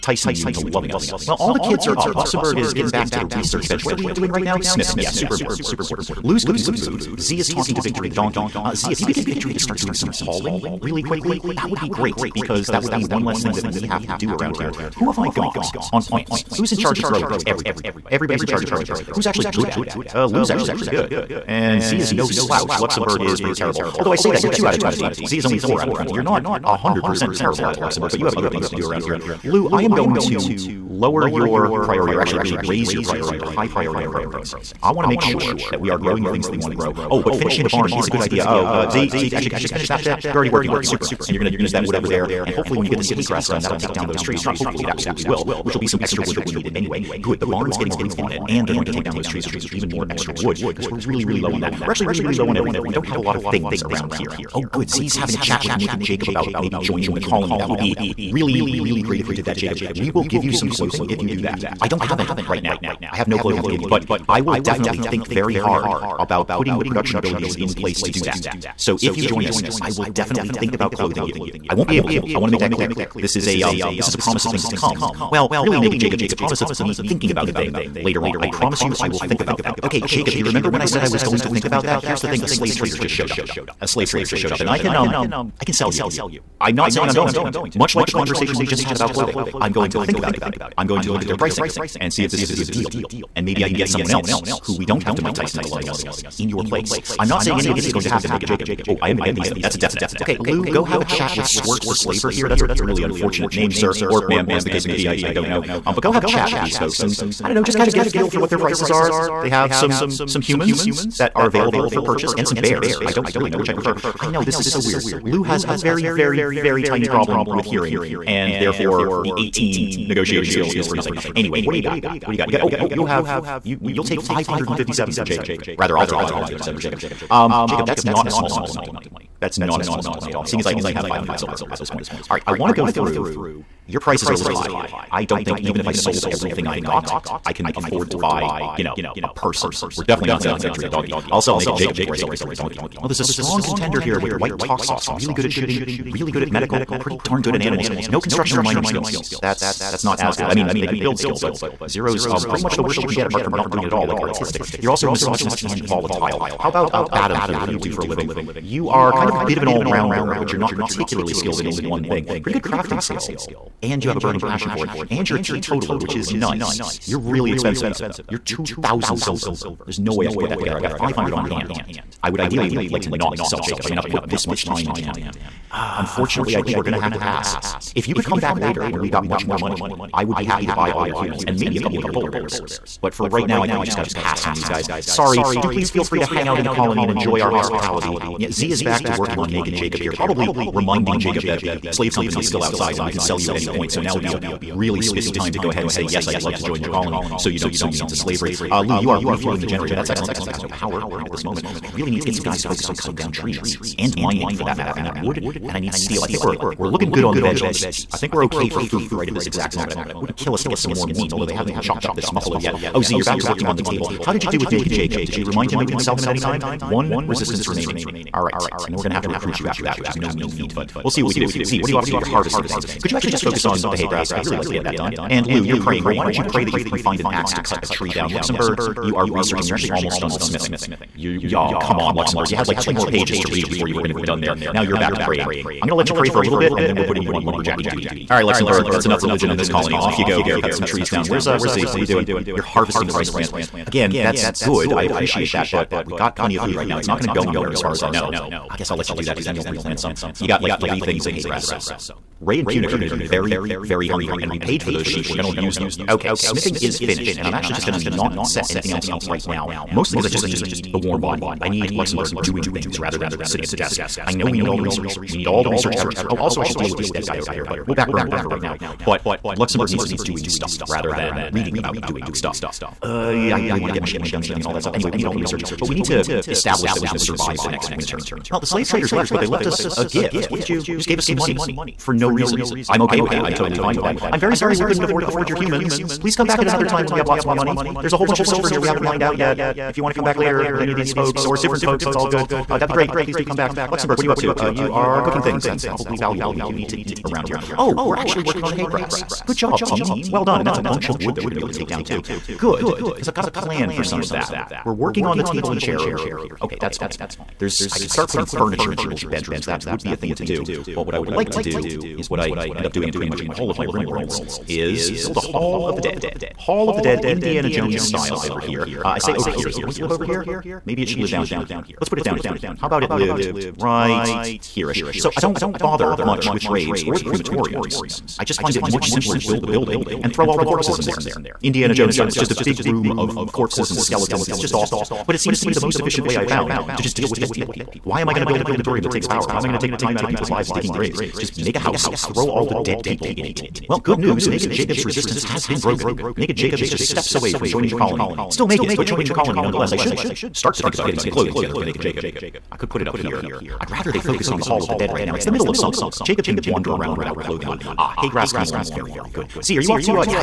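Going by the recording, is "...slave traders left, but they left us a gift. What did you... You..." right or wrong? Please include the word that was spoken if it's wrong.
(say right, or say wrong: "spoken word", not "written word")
right.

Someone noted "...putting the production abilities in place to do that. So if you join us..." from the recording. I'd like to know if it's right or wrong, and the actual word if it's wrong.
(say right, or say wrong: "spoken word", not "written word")
right.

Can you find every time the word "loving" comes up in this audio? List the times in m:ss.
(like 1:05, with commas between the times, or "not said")
0:00, 1:35.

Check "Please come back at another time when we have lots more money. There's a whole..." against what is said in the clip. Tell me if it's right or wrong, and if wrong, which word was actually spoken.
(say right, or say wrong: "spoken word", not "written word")
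right.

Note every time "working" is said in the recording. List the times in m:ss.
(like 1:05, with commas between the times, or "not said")
0:40, 3:09, 3:33, 4:58, 5:04.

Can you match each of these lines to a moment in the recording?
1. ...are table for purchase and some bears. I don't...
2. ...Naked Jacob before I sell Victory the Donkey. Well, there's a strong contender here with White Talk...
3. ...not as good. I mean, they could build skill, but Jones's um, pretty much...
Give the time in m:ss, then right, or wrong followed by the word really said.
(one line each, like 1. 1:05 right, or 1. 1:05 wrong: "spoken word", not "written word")
1. 1:51 wrong: "available", not "table"
2. 2:21 right
3. 2:30 wrong: "Zero", not "Jones".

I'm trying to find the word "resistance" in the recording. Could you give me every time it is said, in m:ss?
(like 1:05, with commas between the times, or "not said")
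3:37, 5:45.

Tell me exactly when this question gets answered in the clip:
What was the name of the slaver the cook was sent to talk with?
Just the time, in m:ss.
1:41.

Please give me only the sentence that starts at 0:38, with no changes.
Oh, uh, Z, Zeke, actually, could you just finish that bit?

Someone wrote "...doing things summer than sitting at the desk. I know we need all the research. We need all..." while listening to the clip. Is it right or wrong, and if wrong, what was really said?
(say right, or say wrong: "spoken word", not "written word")
wrong: "rather", not "summer".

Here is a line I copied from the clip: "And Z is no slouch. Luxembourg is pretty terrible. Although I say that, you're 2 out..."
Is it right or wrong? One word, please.
right.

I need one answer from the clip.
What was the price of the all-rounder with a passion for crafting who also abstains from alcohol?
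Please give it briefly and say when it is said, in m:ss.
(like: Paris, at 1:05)
2,000 silver, at 2:48.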